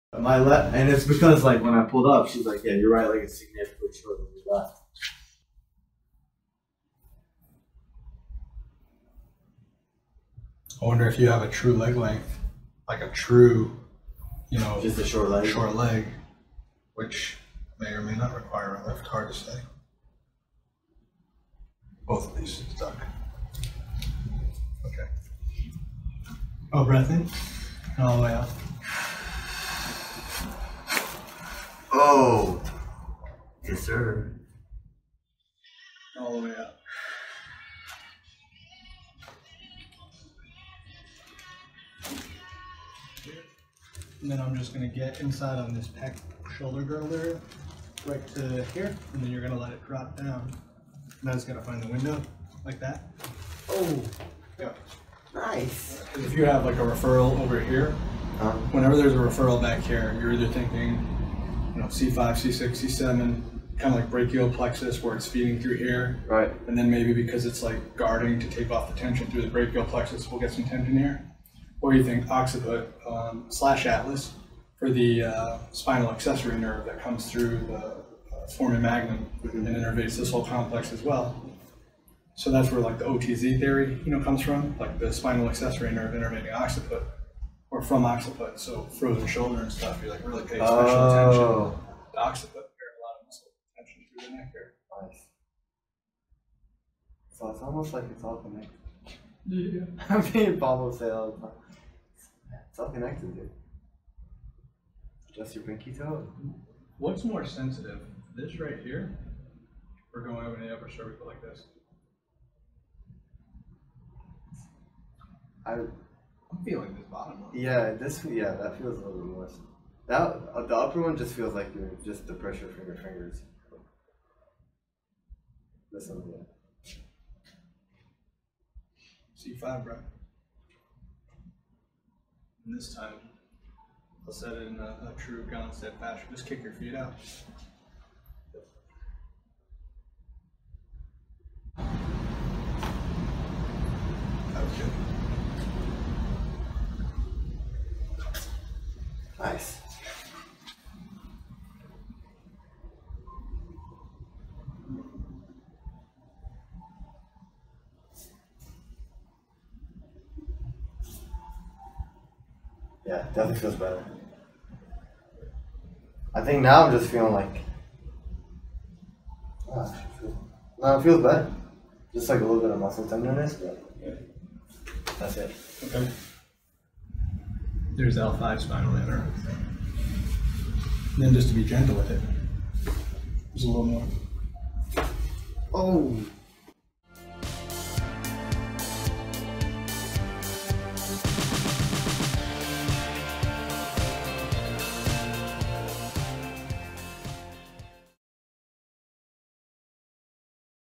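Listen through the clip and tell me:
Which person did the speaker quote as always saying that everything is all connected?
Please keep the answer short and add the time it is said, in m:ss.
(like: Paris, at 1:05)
Bob, at 1:40.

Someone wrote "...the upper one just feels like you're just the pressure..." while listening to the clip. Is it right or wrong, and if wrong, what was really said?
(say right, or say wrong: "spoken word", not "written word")
right.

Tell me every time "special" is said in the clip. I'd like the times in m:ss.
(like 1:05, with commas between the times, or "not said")
1:30.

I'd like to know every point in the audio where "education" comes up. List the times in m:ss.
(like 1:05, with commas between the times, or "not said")
not said.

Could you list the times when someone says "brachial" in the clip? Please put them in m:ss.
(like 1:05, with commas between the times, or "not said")
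1:04, 1:09.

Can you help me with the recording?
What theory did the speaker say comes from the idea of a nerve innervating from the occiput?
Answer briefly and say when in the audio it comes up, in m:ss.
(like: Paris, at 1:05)
OTZ theory, at 1:23.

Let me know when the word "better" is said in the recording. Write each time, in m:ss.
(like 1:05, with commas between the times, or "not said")
2:43, 2:51.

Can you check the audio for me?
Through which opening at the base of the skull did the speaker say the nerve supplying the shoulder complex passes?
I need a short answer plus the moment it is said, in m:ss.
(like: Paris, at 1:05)
foramen magnum, at 1:18.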